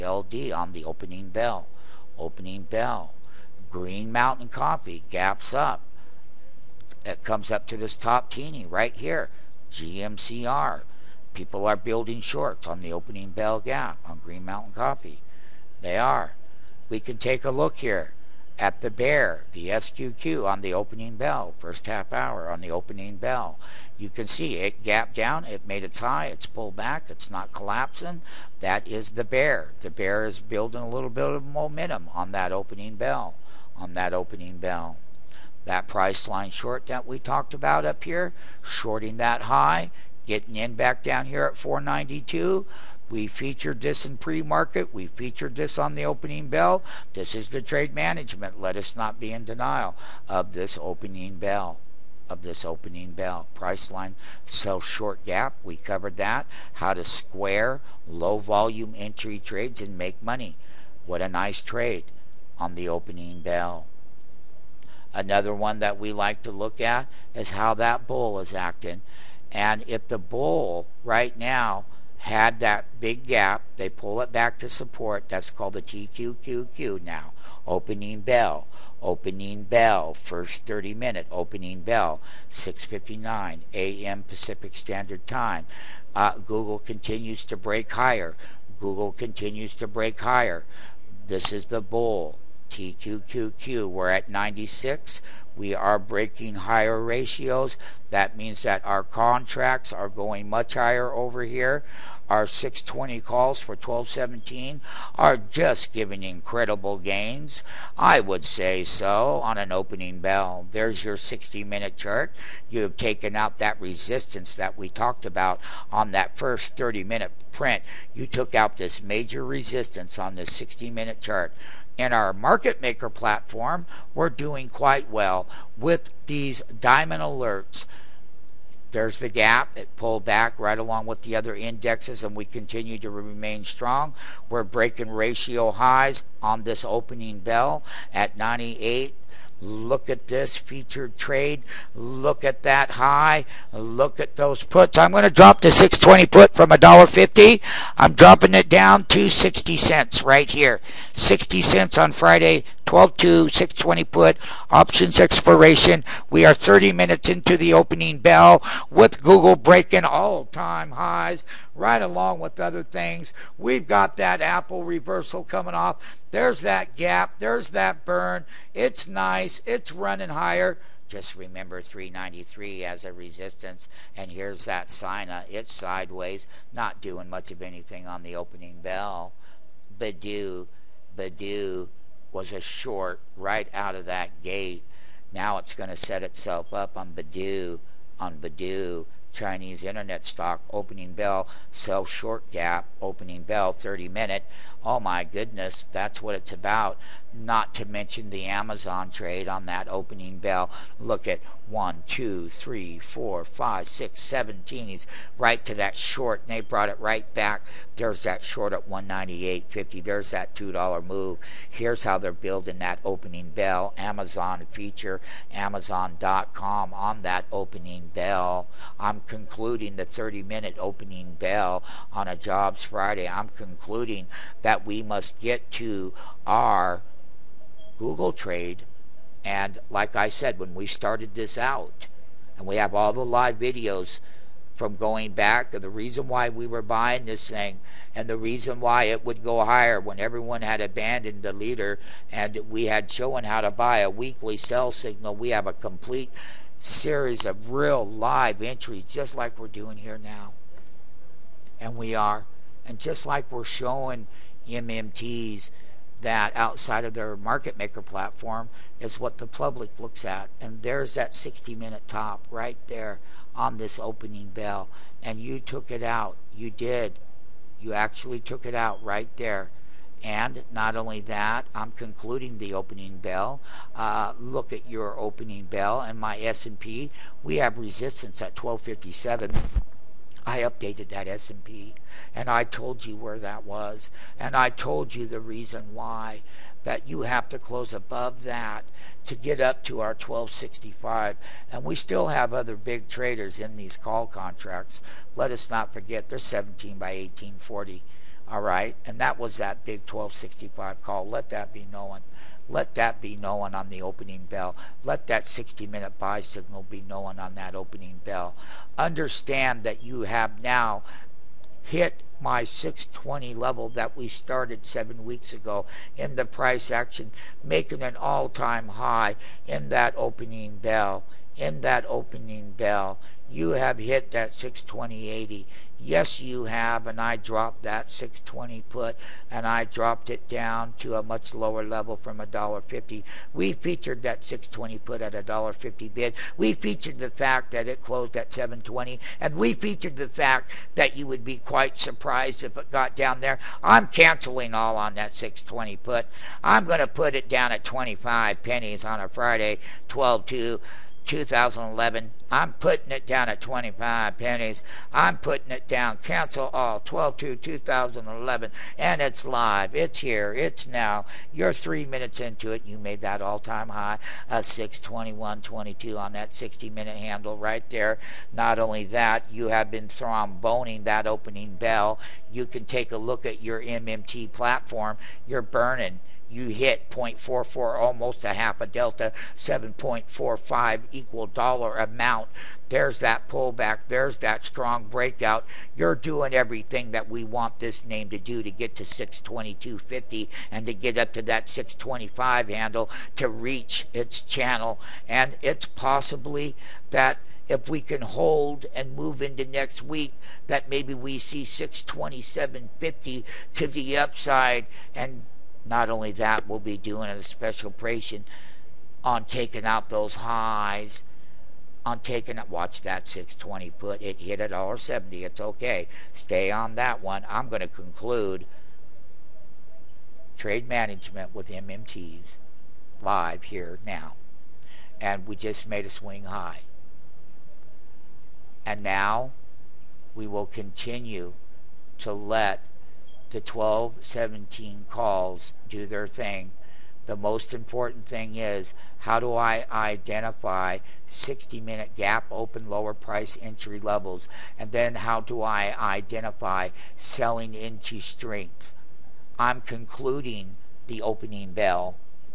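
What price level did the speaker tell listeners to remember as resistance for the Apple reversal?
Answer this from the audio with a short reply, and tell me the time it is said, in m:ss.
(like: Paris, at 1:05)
393, at 2:51.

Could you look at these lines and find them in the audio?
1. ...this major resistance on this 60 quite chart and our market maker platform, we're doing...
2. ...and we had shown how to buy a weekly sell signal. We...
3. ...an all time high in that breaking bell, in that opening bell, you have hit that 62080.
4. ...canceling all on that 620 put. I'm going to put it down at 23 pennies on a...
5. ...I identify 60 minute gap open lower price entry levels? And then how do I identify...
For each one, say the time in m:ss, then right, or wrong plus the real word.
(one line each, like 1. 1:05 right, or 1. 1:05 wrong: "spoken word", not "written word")
1. 1:58 wrong: "minute", not "quite"
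2. 4:02 right
3. 5:18 wrong: "opening", not "breaking"
4. 5:44 wrong: "25", not "23"
5. 7:19 right.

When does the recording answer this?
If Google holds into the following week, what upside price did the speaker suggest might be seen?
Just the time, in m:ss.
6:41.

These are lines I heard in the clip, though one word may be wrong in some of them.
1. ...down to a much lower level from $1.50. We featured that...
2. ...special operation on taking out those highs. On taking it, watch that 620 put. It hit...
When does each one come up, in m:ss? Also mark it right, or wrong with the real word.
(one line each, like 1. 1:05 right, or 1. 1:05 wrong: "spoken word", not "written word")
1. 5:30 right
2. 6:47 right.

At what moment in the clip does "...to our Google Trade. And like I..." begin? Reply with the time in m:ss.
3:45.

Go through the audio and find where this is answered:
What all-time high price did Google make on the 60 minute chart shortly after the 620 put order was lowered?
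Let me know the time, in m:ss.
6:04.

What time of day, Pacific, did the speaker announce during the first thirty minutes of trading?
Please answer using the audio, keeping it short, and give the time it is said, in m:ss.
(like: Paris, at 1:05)
6:59 a.m., at 1:22.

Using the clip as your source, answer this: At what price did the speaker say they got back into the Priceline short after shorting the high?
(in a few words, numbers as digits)
492.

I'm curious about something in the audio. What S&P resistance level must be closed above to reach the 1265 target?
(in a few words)
1257.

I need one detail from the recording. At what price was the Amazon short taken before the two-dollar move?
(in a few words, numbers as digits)
198.50.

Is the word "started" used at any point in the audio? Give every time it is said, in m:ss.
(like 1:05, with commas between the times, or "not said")
3:50, 5:14.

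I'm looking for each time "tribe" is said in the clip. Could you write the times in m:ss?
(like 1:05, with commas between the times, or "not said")
not said.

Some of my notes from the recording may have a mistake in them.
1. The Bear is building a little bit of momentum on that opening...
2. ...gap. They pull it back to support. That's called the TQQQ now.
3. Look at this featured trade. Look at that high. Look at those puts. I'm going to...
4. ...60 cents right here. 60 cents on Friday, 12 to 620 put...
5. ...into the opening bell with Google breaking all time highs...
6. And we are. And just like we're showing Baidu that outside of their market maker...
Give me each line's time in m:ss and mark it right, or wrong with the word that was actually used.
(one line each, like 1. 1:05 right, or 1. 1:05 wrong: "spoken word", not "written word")
1. 0:29 right
2. 1:13 right
3. 2:19 right
4. 2:29 right
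5. 2:37 right
6. 4:11 wrong: "MMTs", not "Baidu".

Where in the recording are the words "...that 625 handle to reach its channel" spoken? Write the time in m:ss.
6:31.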